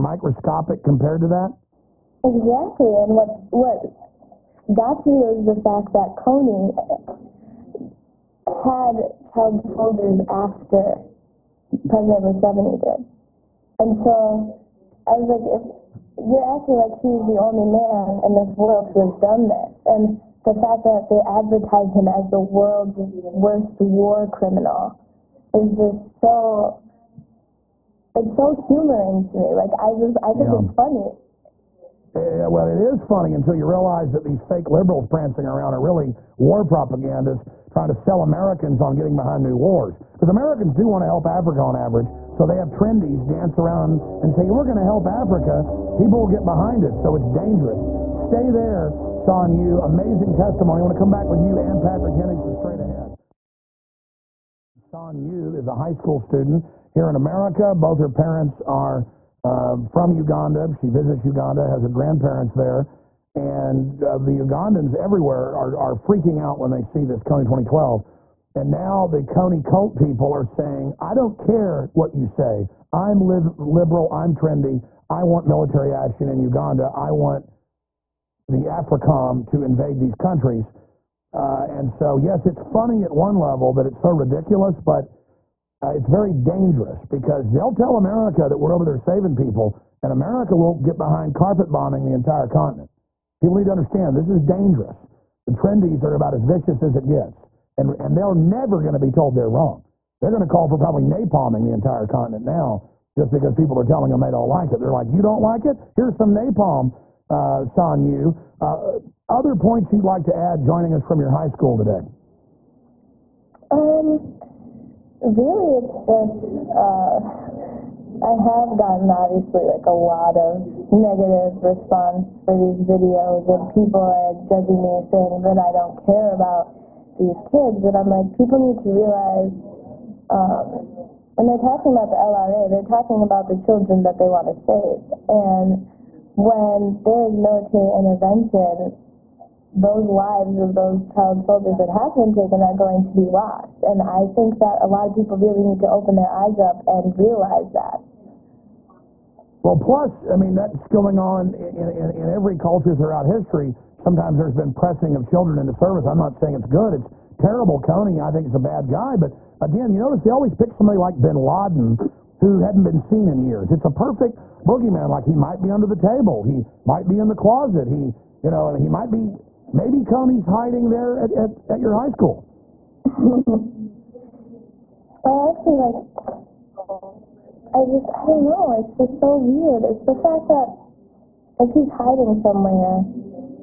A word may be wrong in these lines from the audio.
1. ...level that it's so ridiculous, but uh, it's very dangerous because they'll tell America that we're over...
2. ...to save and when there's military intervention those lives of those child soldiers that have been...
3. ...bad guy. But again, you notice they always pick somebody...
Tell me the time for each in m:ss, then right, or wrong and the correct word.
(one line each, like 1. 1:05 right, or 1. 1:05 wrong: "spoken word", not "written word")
1. 1:23 right
2. 2:14 right
3. 2:38 right.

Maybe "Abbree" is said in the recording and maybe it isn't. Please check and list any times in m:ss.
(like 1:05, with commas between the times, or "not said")
not said.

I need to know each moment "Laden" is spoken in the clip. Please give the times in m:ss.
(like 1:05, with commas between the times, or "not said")
2:41.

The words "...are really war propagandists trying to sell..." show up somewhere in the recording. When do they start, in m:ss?
0:35.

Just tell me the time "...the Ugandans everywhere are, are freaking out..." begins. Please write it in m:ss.
1:04.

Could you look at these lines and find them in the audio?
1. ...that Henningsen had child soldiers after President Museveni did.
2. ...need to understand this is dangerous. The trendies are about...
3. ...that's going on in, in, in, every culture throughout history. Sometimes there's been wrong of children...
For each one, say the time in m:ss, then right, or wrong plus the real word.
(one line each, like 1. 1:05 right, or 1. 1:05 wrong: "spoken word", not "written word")
1. 0:05 wrong: "Kony", not "Henningsen"
2. 1:33 right
3. 2:30 wrong: "pressing", not "wrong".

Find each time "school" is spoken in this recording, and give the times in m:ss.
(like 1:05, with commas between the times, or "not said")
0:55, 1:51, 2:52.